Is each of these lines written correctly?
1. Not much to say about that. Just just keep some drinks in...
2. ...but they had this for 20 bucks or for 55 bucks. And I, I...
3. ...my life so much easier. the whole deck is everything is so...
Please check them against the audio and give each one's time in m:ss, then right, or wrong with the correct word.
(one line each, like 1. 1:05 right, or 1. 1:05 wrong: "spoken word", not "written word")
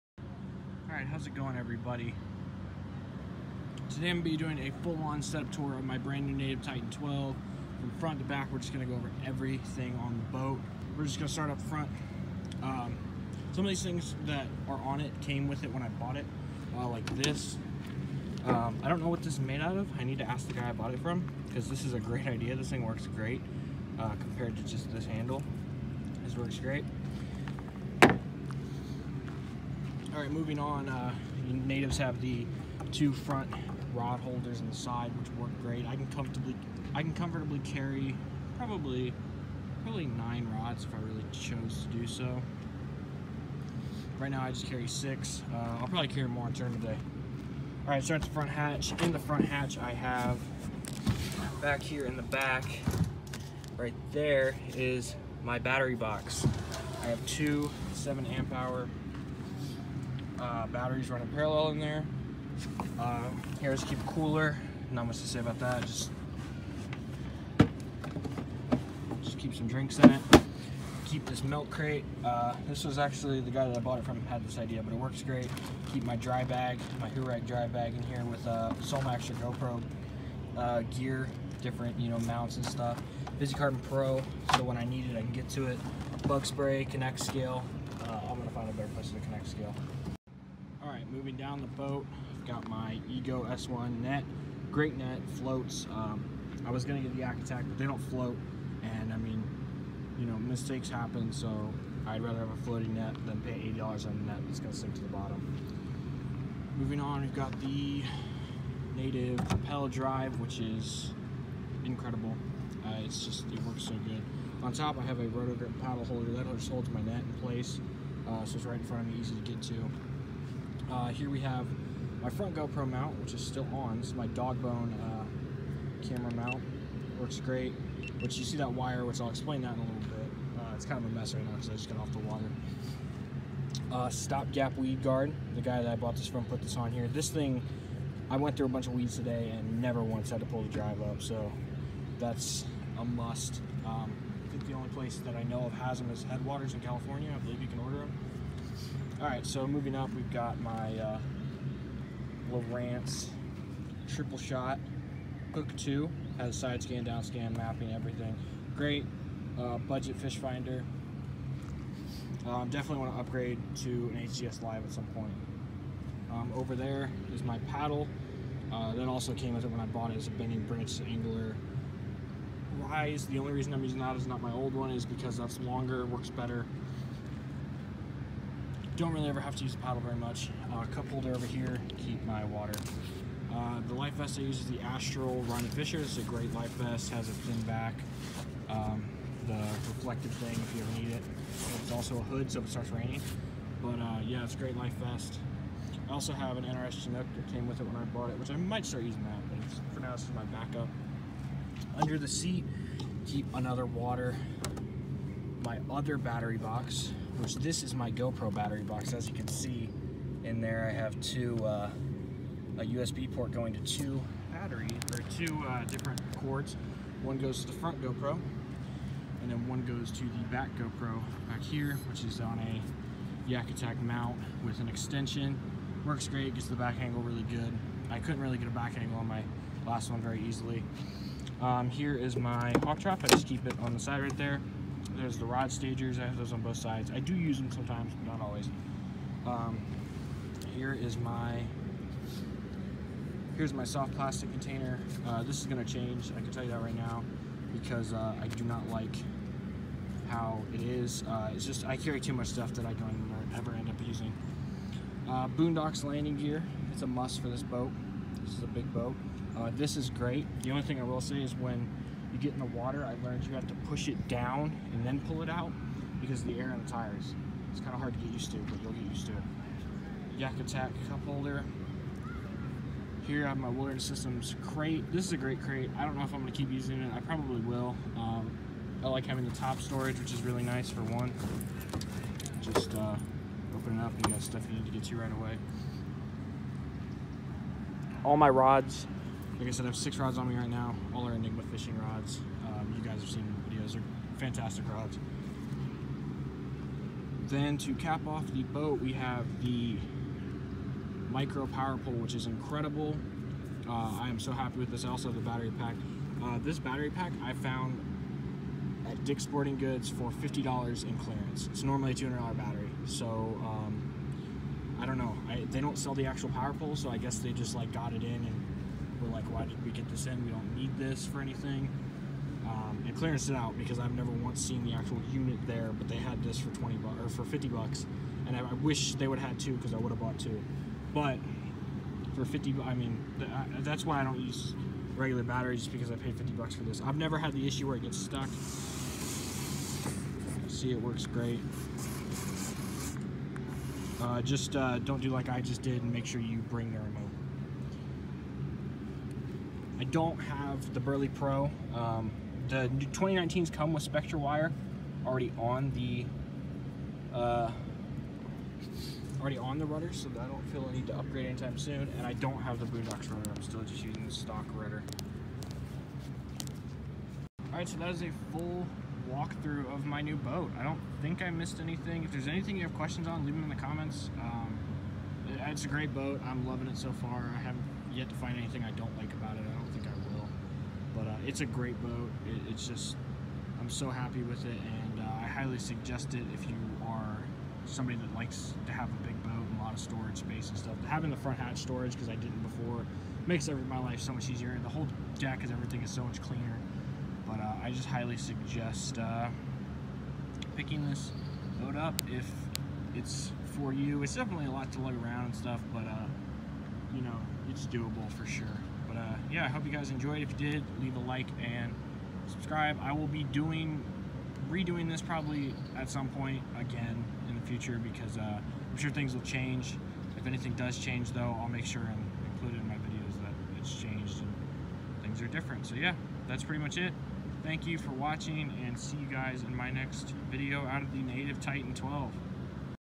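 1. 1:04 right
2. 5:25 wrong: "50", not "55"
3. 6:33 right.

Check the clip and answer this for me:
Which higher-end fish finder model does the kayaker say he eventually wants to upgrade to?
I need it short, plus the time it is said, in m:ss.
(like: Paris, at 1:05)
HDS Live, at 2:44.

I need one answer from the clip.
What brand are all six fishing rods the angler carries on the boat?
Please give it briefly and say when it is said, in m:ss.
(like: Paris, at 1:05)
Enigma, at 4:51.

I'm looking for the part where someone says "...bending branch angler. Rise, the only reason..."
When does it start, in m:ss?
2:50.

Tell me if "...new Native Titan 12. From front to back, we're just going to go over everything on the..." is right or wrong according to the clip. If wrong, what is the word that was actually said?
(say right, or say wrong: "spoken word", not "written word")
right.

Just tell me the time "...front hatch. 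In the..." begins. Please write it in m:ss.
0:48.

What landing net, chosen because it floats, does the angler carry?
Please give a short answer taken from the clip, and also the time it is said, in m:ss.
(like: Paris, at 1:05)
Ego S1, at 1:33.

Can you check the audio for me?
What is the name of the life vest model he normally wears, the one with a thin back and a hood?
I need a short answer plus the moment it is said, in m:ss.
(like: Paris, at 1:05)
Astral Ronny Fisher, at 3:04.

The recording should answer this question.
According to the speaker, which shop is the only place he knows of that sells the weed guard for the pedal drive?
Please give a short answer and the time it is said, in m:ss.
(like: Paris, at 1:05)
Headwaters, at 2:26.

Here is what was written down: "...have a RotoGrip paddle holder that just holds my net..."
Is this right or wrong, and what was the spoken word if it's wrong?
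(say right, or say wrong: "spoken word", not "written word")
right.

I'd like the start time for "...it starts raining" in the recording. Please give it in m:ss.
3:12.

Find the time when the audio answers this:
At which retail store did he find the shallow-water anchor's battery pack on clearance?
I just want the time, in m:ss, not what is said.
5:09.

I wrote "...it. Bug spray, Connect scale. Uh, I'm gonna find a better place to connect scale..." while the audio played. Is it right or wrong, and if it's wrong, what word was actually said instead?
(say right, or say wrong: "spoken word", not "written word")
right.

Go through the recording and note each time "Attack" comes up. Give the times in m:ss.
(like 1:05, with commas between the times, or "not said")
1:37, 3:43, 4:30.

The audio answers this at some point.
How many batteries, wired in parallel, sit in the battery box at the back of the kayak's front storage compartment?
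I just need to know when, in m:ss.
0:57.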